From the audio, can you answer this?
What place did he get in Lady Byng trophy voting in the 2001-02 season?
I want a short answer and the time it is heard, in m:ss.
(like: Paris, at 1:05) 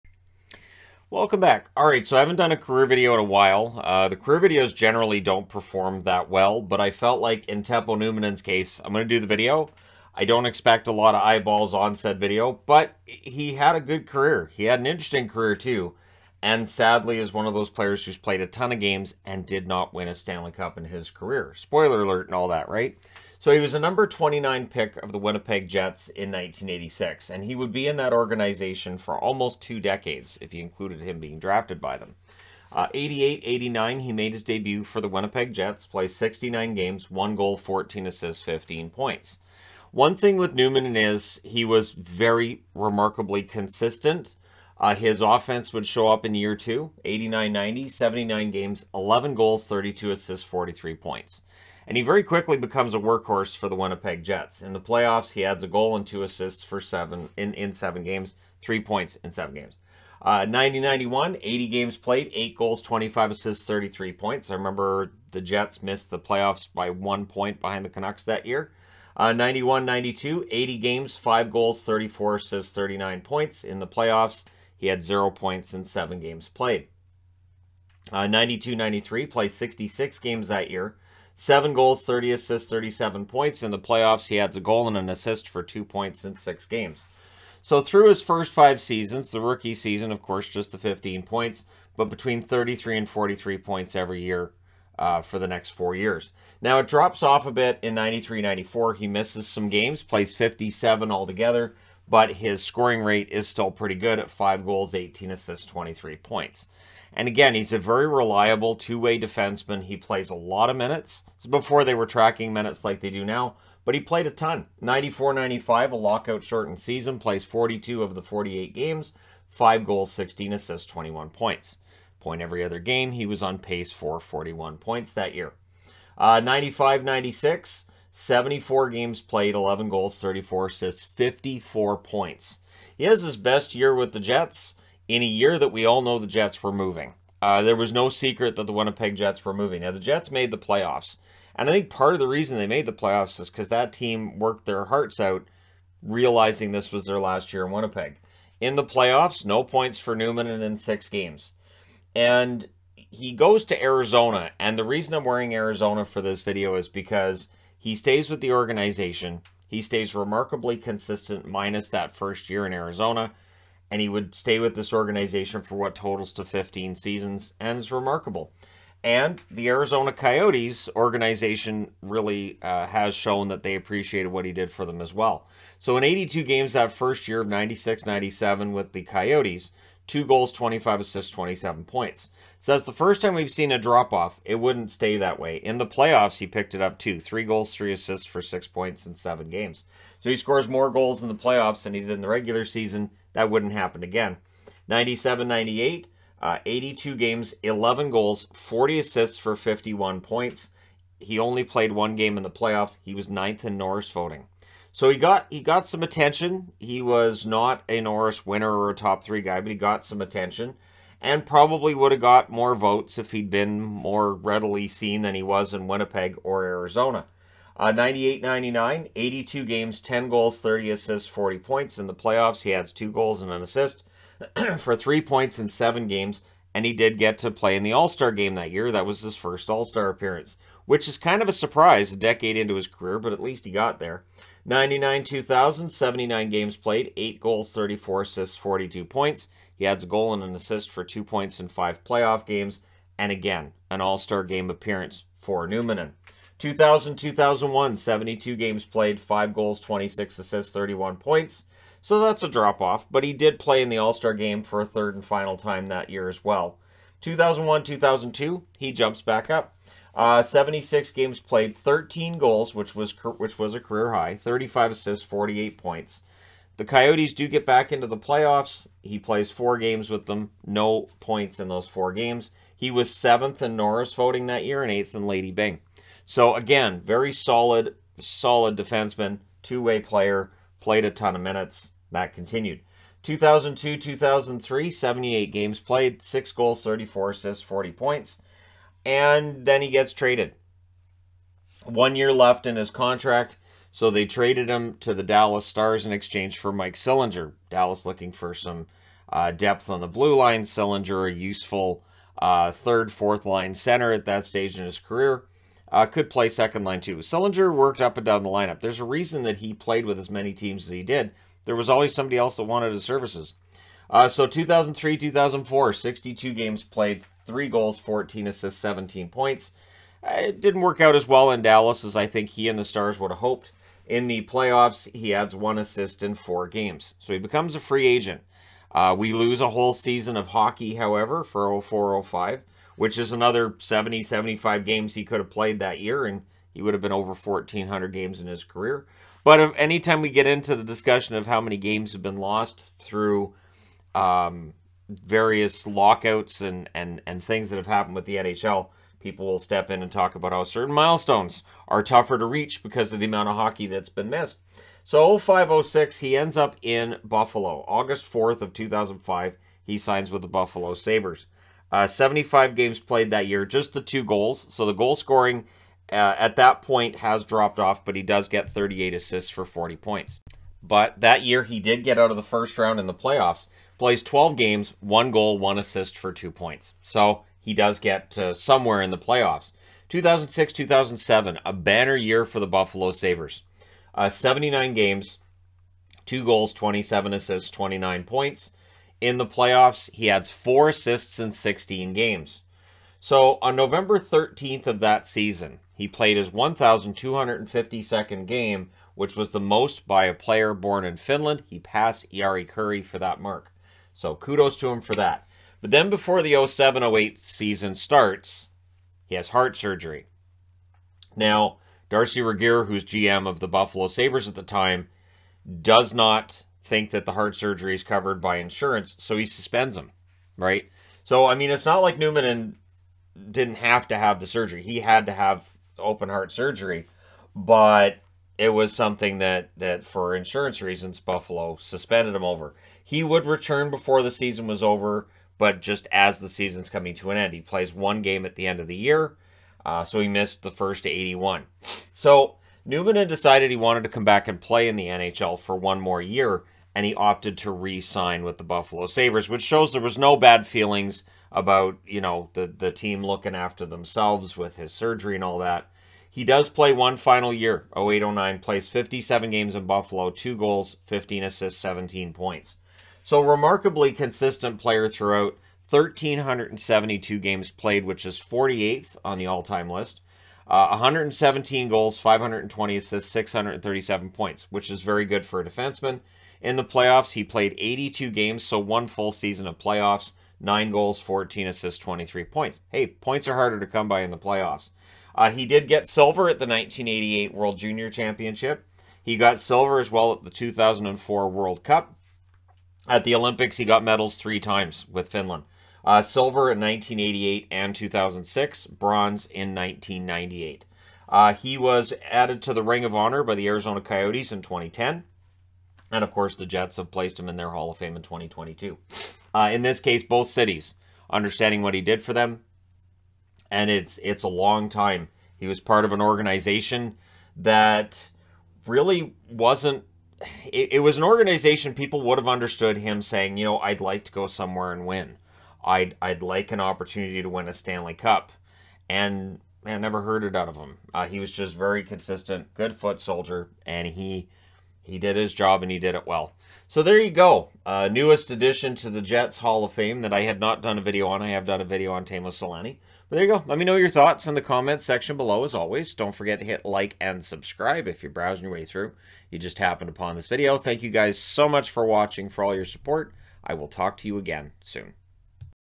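eighth, at 4:34.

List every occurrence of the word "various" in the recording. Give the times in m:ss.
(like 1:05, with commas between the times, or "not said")
5:45.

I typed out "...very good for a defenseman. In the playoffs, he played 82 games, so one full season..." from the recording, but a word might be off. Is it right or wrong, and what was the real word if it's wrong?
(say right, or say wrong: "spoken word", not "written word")
right.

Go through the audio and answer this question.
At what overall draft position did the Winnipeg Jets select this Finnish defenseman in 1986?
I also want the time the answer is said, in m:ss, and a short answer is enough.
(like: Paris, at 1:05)
29, at 0:23.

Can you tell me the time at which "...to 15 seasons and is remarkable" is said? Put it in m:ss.
2:46.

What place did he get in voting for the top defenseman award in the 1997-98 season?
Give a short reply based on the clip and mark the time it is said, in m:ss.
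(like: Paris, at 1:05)
ninth, at 3:23.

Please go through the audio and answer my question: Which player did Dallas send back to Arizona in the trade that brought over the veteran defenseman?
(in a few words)
Mike Sillinger.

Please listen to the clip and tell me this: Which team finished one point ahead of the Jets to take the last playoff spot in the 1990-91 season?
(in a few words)
Canucks.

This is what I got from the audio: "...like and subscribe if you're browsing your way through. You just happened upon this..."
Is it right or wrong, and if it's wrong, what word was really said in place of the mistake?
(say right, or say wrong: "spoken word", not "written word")
right.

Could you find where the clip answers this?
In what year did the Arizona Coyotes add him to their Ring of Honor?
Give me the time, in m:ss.
8:24.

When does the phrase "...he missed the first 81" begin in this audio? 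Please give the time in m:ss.
7:20.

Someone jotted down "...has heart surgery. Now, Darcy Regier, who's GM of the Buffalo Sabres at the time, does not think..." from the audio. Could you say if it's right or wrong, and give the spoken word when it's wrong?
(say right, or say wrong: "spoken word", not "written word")
right.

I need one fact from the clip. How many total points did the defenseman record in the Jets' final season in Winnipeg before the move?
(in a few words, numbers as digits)
54.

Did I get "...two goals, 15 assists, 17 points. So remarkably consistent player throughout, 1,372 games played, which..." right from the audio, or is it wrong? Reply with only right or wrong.
right.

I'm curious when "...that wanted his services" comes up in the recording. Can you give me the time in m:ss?
5:12.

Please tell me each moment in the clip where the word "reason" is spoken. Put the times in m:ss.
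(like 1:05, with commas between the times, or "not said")
2:22, 2:34, 5:09, 7:10.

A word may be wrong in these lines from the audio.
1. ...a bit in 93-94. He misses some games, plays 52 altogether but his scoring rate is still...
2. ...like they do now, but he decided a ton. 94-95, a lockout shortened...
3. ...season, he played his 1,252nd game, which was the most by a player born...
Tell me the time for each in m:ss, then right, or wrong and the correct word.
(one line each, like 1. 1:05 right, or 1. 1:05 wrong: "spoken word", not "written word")
1. 1:37 wrong: "57", not "52"
2. 1:52 wrong: "played", not "decided"
3. 6:35 right.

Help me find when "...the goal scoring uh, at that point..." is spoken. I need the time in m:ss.
6:04.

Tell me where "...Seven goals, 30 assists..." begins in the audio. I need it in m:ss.
1:21.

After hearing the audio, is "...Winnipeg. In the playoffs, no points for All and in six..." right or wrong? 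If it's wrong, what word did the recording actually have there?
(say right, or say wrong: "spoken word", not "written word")
wrong: "Numminen", not "All".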